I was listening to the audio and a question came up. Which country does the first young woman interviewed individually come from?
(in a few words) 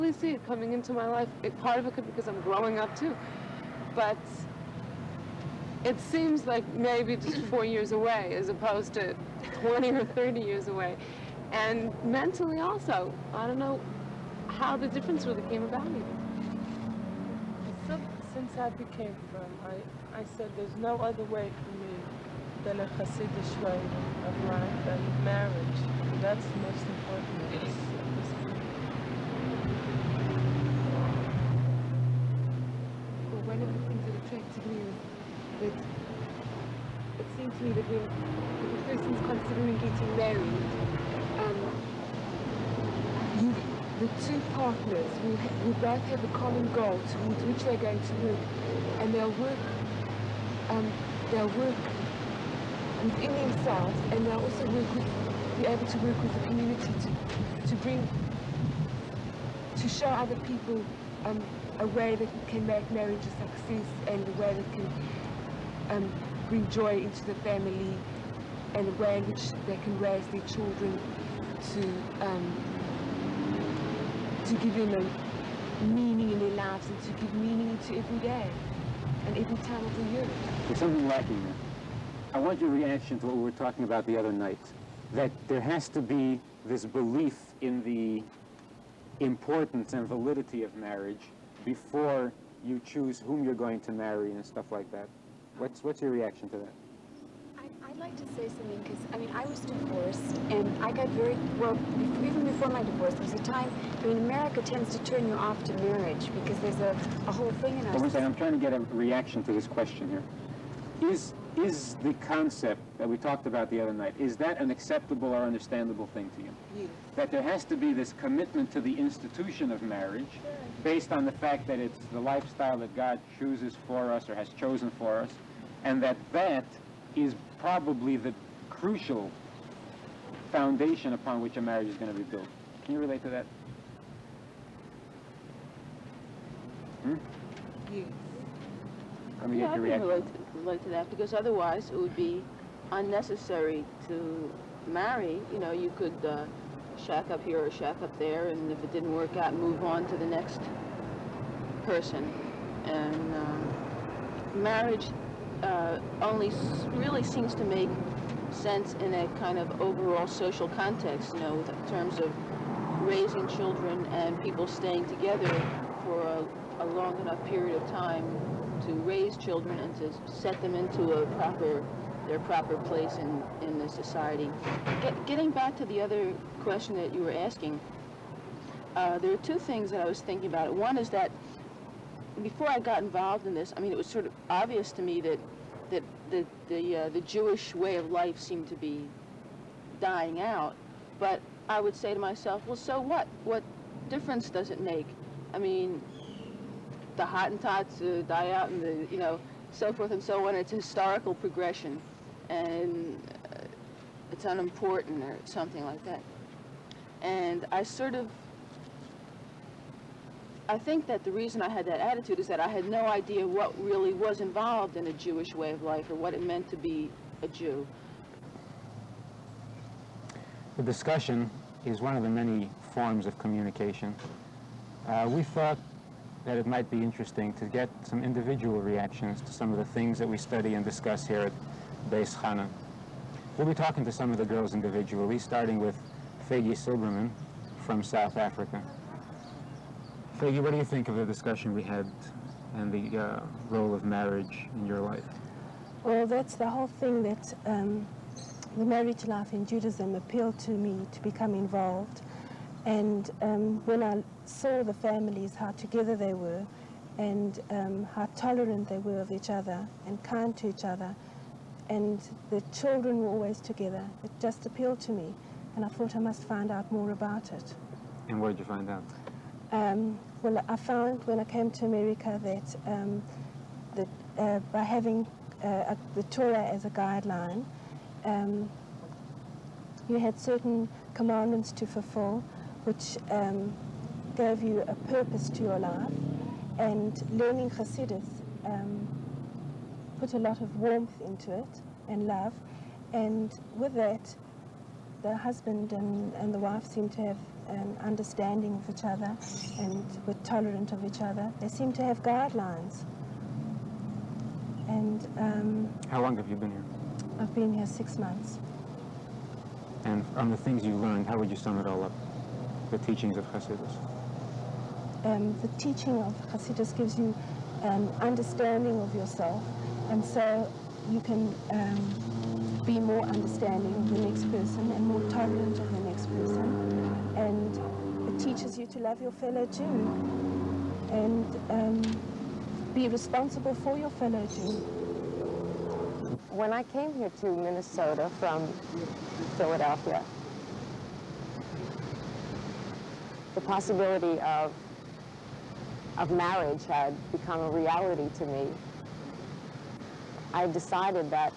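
South Africa.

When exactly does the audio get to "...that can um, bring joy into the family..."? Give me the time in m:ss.
1:04.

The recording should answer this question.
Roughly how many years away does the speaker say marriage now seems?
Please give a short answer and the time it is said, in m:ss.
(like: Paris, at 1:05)
4 years, at 0:07.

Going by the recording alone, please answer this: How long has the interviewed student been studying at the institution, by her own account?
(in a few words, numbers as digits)
6 months.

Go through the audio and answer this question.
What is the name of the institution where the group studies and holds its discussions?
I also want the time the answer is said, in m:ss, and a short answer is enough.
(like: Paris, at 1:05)
Beis Chana, at 3:52.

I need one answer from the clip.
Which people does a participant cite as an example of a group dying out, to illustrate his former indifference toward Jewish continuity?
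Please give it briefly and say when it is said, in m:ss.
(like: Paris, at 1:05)
Hottentots, at 3:17.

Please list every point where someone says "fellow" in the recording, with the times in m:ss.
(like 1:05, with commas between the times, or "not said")
5:29, 5:34.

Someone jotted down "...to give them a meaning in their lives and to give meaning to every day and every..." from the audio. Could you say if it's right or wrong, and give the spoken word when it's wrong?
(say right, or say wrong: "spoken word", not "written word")
right.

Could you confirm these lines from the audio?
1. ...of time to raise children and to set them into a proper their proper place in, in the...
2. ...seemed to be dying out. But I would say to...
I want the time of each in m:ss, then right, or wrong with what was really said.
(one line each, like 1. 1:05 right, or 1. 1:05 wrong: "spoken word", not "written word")
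1. 2:47 right
2. 3:08 right.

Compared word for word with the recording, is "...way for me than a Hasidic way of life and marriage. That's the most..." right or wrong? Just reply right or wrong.
right.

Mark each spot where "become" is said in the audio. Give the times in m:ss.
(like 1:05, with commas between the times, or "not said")
4:11, 5:47.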